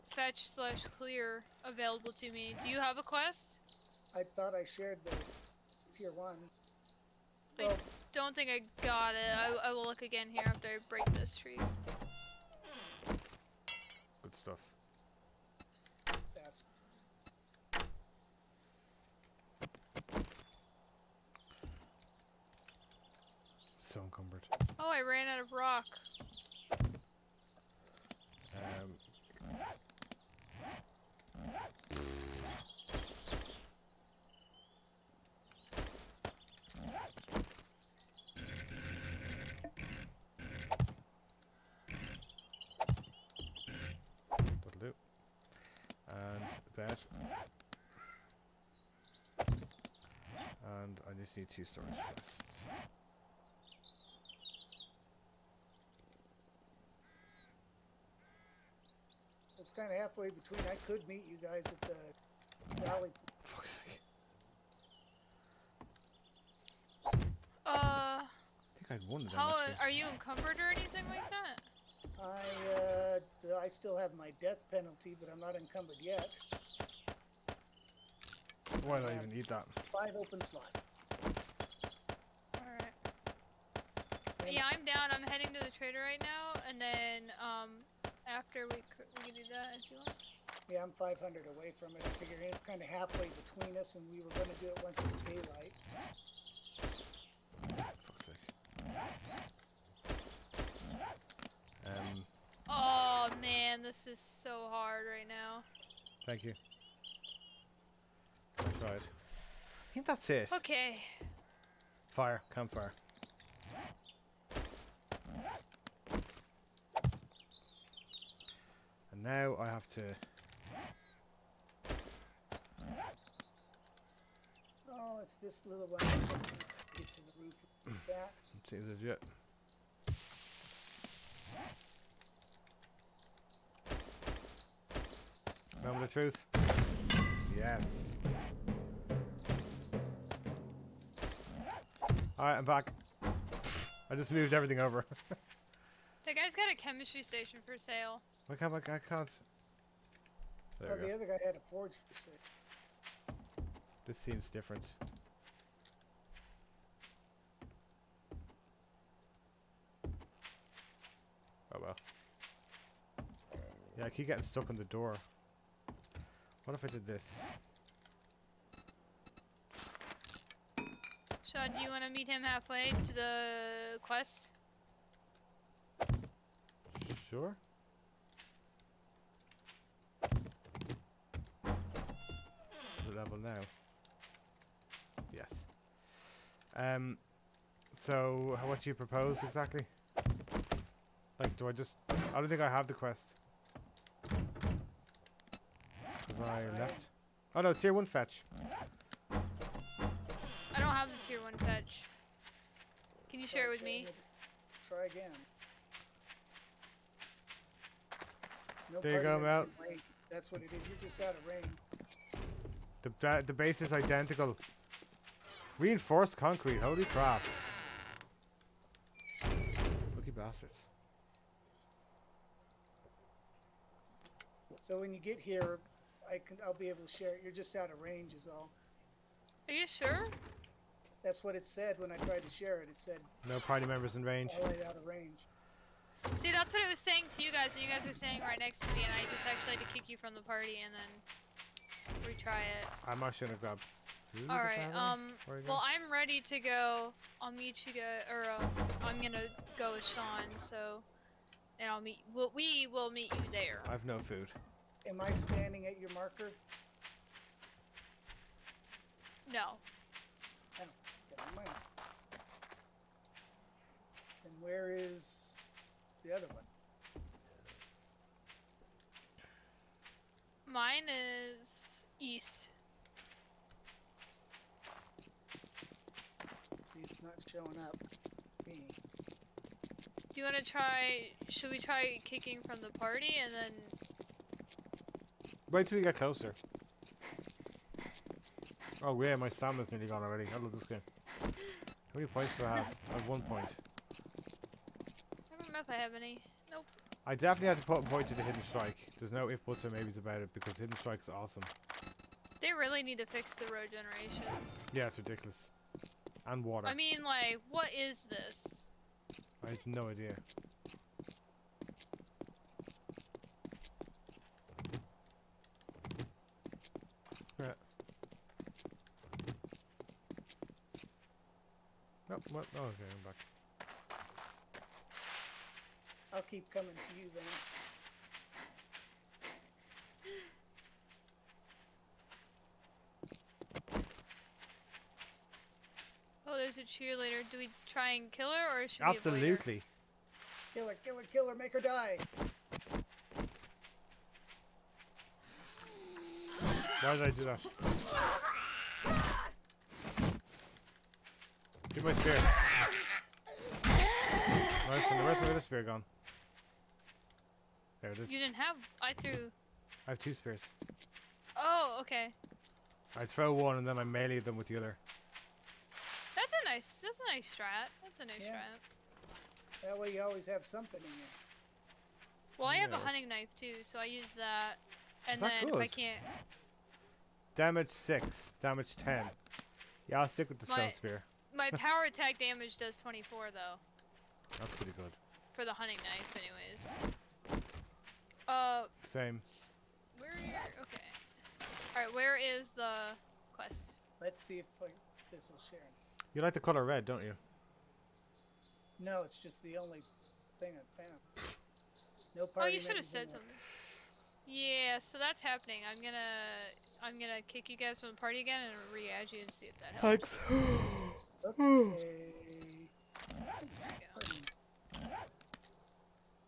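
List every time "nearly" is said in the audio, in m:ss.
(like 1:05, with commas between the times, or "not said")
4:49.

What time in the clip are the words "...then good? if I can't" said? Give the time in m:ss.
6:15.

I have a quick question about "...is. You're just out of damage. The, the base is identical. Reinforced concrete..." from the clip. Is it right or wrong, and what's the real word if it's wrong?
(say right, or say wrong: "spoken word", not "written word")
wrong: "range", not "damage".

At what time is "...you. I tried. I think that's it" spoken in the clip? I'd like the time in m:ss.
1:46.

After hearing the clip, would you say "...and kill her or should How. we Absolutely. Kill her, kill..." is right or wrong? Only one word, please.
wrong.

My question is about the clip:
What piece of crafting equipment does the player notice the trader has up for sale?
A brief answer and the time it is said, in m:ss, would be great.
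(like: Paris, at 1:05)
chemistry station, at 2:26.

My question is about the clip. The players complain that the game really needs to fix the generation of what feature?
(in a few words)
road generation.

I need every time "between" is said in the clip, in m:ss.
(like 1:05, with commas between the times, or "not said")
1:00, 1:33.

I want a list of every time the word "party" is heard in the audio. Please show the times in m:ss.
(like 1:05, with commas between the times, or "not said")
3:53, 4:00, 4:42, 6:48.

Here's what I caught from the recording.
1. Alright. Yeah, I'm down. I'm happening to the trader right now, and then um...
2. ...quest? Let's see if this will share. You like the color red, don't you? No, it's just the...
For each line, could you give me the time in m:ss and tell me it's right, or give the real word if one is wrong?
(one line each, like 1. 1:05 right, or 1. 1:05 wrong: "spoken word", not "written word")
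1. 1:22 wrong: "heading", not "happening"
2. 6:33 right.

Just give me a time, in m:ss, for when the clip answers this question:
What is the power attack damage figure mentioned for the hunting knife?
6:22.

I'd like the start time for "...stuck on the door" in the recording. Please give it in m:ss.
2:44.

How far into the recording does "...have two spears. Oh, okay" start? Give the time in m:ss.
6:00.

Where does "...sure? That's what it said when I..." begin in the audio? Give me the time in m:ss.
3:49.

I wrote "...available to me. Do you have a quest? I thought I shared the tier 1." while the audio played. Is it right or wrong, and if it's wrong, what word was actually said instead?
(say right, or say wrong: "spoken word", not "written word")
right.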